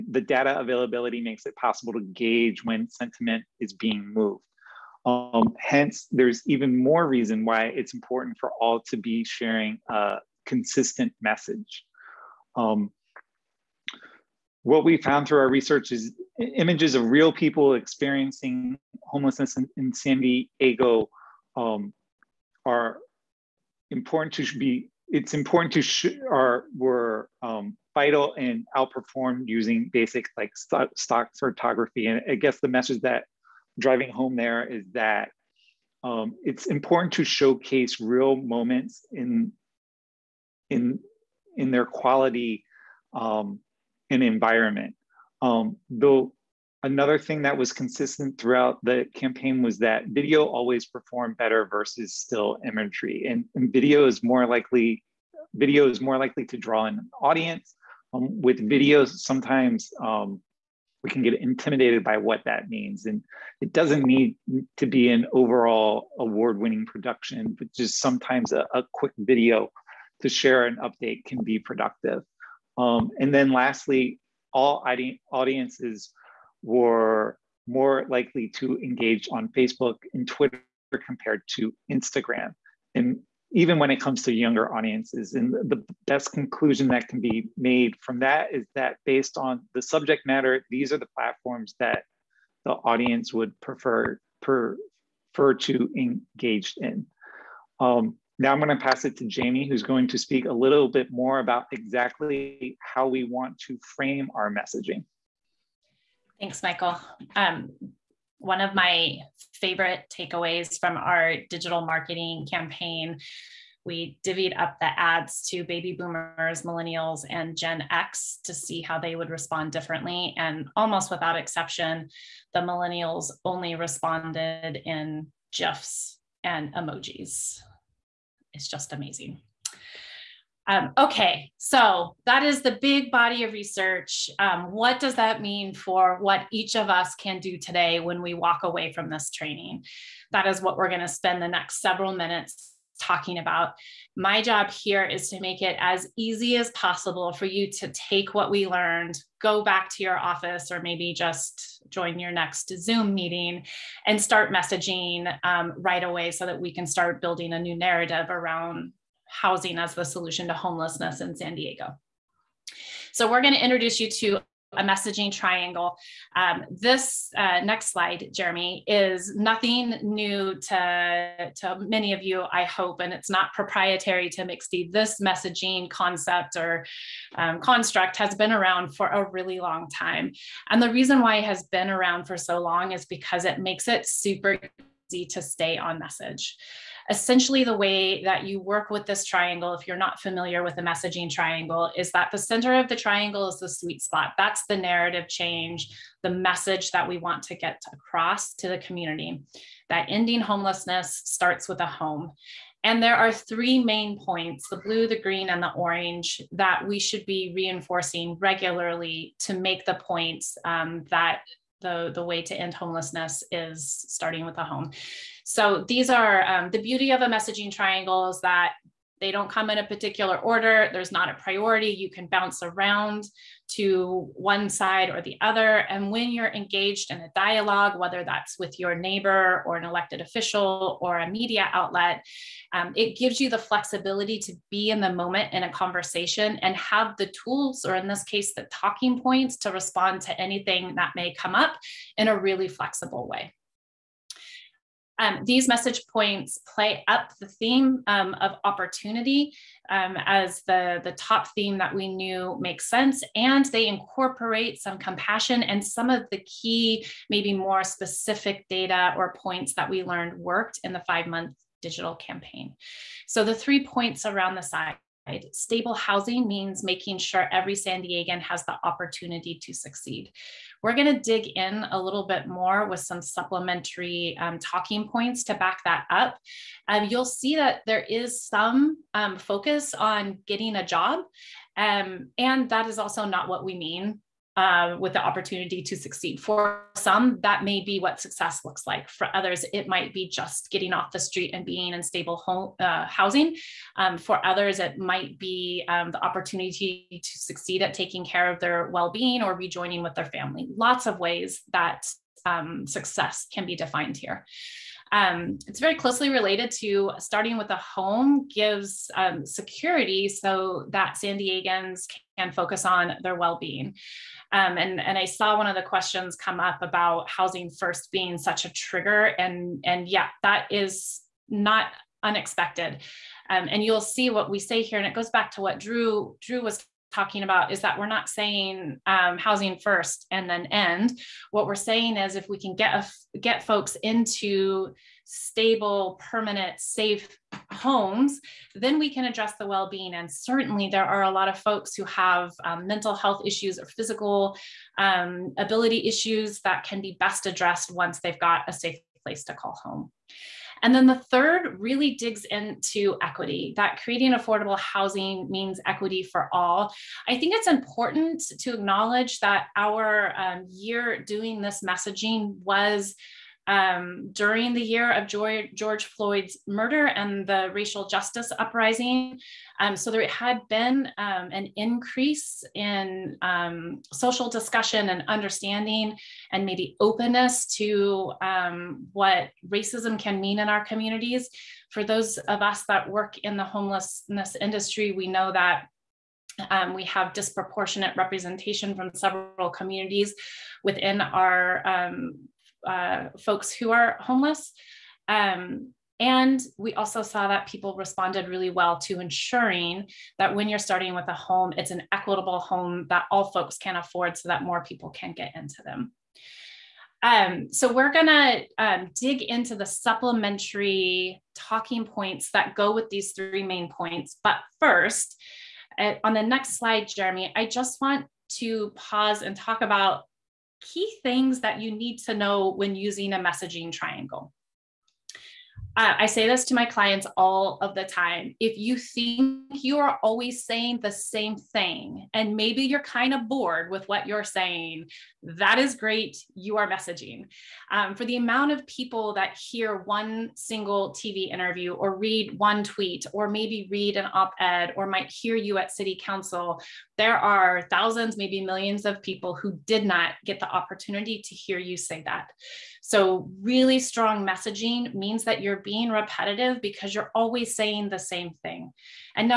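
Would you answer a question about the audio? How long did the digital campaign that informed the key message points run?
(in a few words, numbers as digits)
5 months.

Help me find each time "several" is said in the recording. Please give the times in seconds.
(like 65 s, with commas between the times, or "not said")
141 s, 389 s.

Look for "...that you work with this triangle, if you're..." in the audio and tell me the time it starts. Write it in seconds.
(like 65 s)
188 s.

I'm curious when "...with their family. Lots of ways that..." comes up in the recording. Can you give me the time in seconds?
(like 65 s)
300 s.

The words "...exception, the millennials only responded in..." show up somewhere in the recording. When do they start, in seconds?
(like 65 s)
121 s.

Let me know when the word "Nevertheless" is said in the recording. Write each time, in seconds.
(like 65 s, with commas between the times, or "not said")
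not said.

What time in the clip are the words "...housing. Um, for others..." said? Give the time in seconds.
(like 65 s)
293 s.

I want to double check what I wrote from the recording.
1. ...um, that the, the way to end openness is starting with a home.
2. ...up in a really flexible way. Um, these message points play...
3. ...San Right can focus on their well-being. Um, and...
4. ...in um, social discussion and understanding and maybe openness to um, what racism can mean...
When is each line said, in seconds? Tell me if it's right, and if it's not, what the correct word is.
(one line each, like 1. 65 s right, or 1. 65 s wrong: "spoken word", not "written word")
1. 210 s wrong: "homelessness", not "openness"
2. 241 s right
3. 311 s wrong: "Diegans", not "Right"
4. 372 s right.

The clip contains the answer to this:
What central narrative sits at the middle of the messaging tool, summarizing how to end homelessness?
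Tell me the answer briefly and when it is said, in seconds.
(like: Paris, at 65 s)
Ending homelessness starts with a home, at 200 s.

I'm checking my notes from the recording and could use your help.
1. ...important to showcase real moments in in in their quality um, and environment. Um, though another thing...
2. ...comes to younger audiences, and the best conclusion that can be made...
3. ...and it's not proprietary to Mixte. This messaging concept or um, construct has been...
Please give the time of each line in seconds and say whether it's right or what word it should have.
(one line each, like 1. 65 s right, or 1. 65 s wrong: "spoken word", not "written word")
1. 36 s right
2. 83 s right
3. 172 s right.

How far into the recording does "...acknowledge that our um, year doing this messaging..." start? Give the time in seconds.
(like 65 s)
358 s.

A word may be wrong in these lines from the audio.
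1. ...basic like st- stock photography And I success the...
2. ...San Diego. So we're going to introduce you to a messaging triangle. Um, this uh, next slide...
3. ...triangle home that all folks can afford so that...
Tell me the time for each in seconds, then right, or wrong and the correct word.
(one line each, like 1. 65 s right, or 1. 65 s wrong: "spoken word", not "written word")
1. 29 s wrong: "guess", not "success"
2. 161 s right
3. 402 s wrong: "equitable", not "triangle".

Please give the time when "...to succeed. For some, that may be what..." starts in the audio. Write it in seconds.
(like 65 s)
285 s.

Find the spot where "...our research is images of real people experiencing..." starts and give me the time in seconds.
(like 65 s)
15 s.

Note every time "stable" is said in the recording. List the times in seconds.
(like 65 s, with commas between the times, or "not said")
265 s, 292 s, 335 s.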